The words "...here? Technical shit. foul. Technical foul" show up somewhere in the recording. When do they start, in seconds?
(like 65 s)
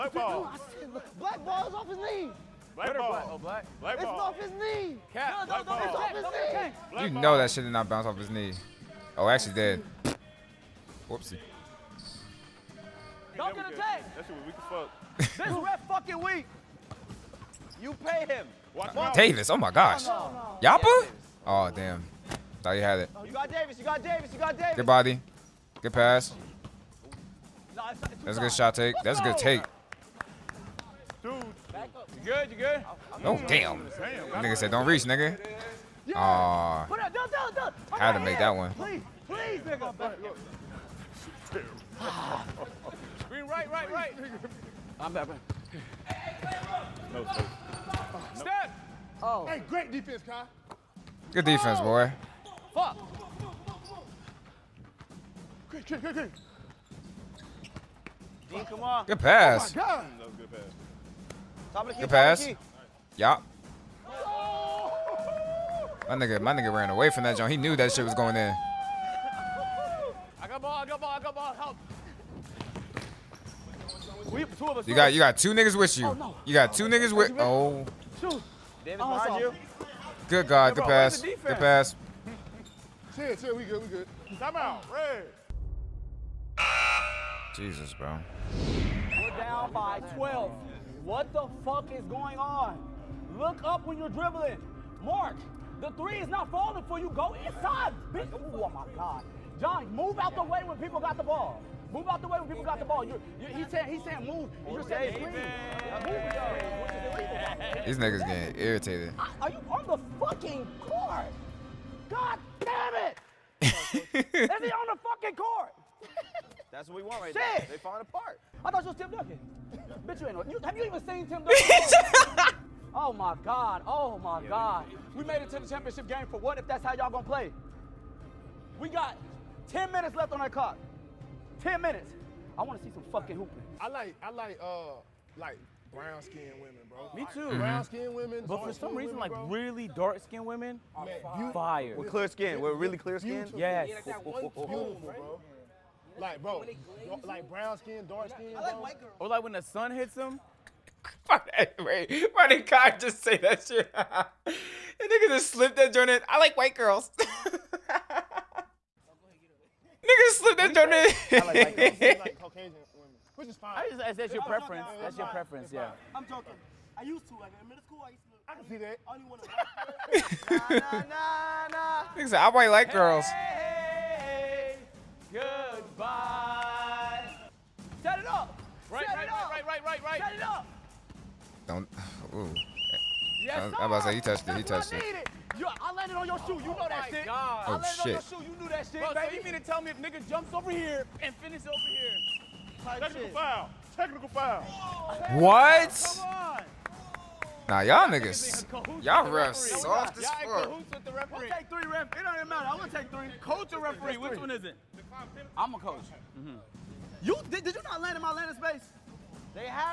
191 s.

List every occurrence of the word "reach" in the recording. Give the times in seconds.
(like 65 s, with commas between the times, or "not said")
34 s.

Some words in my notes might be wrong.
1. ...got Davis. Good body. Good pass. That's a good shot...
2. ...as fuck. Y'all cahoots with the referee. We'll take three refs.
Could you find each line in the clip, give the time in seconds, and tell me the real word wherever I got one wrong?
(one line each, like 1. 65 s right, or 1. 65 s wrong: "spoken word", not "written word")
1. 24 s right
2. 200 s right.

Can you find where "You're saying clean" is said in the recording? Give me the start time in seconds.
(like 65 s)
104 s.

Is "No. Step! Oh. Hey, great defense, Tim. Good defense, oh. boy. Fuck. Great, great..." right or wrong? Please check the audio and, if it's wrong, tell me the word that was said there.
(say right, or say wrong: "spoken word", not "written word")
wrong: "Kai", not "Tim".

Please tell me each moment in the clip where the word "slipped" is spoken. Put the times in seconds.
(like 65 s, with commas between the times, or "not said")
155 s, 160 s.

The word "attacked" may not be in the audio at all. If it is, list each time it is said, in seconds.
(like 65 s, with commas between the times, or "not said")
13 s.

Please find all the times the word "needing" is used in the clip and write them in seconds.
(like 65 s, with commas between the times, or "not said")
not said.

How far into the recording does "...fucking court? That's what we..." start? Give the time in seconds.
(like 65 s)
115 s.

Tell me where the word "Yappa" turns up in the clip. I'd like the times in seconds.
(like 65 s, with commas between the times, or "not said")
20 s.